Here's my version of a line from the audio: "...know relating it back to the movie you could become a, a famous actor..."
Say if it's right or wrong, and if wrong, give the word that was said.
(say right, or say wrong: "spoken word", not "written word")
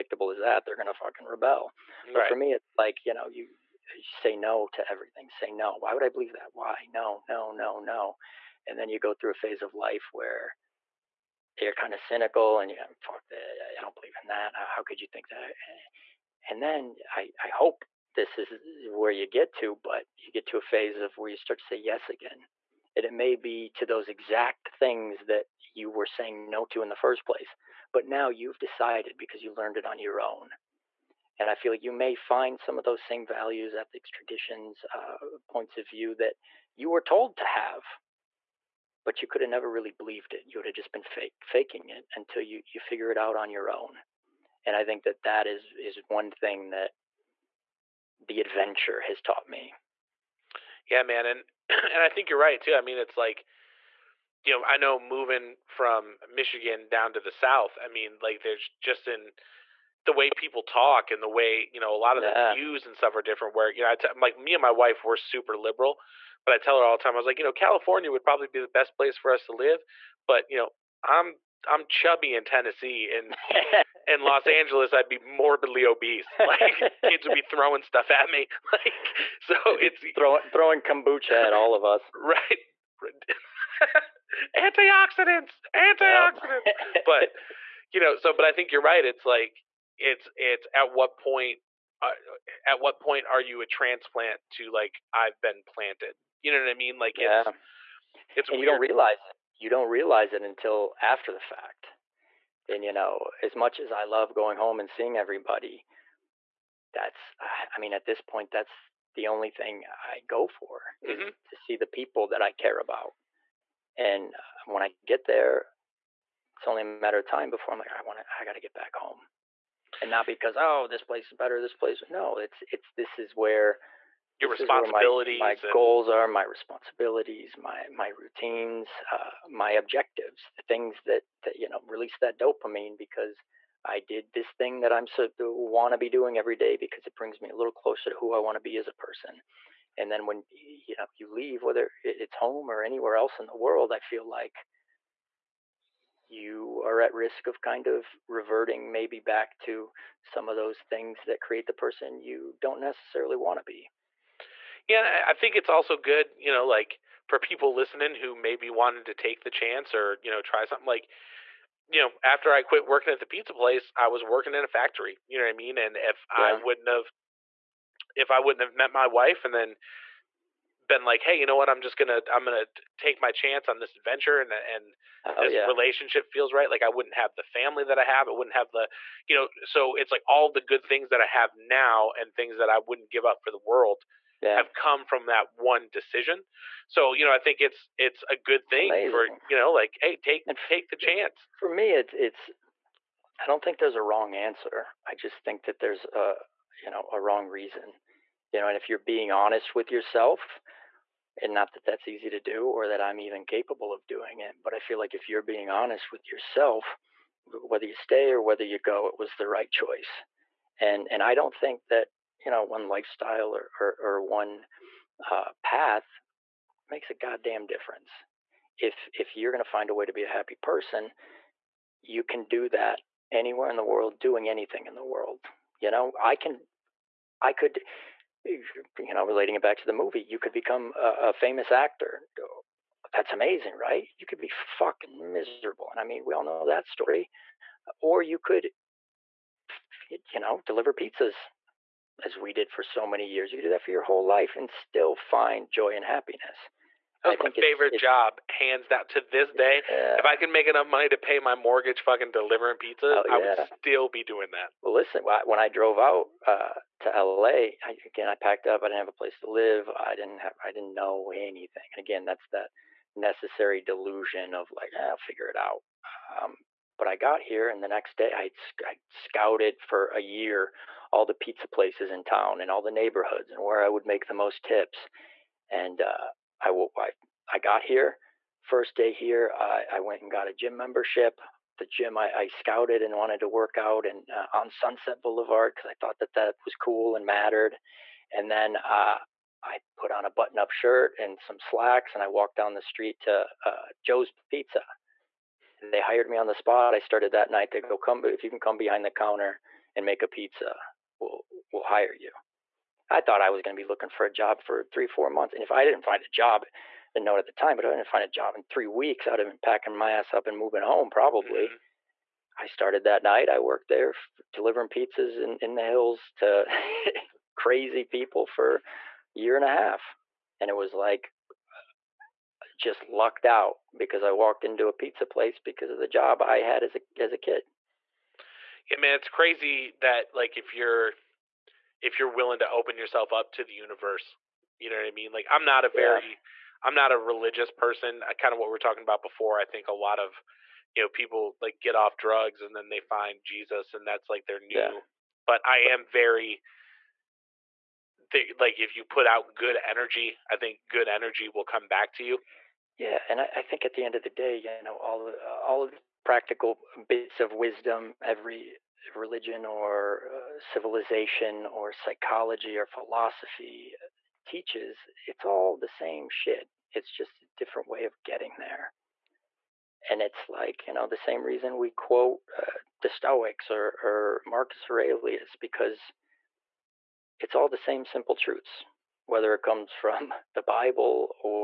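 right.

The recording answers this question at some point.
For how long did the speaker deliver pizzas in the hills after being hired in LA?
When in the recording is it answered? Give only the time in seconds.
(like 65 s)
318 s.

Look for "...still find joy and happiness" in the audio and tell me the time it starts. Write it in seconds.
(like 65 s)
244 s.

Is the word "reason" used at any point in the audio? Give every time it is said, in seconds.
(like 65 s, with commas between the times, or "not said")
197 s, 371 s.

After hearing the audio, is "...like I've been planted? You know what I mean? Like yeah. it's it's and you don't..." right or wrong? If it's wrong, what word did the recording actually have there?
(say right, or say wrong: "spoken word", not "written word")
right.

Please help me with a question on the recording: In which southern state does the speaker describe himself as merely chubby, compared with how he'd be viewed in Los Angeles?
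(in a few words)
Tennessee.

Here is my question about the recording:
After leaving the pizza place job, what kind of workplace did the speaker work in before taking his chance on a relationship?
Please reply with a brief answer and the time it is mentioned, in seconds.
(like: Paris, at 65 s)
A factory, at 164 s.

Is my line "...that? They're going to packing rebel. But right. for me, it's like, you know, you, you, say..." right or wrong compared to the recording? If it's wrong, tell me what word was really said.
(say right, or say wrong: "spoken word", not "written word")
wrong: "fucking", not "packing".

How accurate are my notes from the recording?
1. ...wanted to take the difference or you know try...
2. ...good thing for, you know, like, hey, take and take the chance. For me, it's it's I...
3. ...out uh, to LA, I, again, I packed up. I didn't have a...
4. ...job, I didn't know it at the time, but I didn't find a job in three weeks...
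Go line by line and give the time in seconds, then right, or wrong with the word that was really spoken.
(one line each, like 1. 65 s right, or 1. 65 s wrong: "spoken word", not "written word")
1. 158 s wrong: "chance", not "difference"
2. 188 s right
3. 255 s right
4. 306 s right.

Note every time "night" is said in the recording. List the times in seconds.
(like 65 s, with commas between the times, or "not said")
297 s, 313 s.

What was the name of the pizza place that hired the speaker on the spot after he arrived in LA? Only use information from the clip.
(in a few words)
Joe's Pizza.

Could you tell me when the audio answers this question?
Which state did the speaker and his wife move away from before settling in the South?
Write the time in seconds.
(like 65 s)
56 s.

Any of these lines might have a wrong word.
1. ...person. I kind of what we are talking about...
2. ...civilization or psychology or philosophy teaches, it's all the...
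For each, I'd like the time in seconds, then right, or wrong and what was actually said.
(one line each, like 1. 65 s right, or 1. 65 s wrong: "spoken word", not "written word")
1. 337 s right
2. 360 s right.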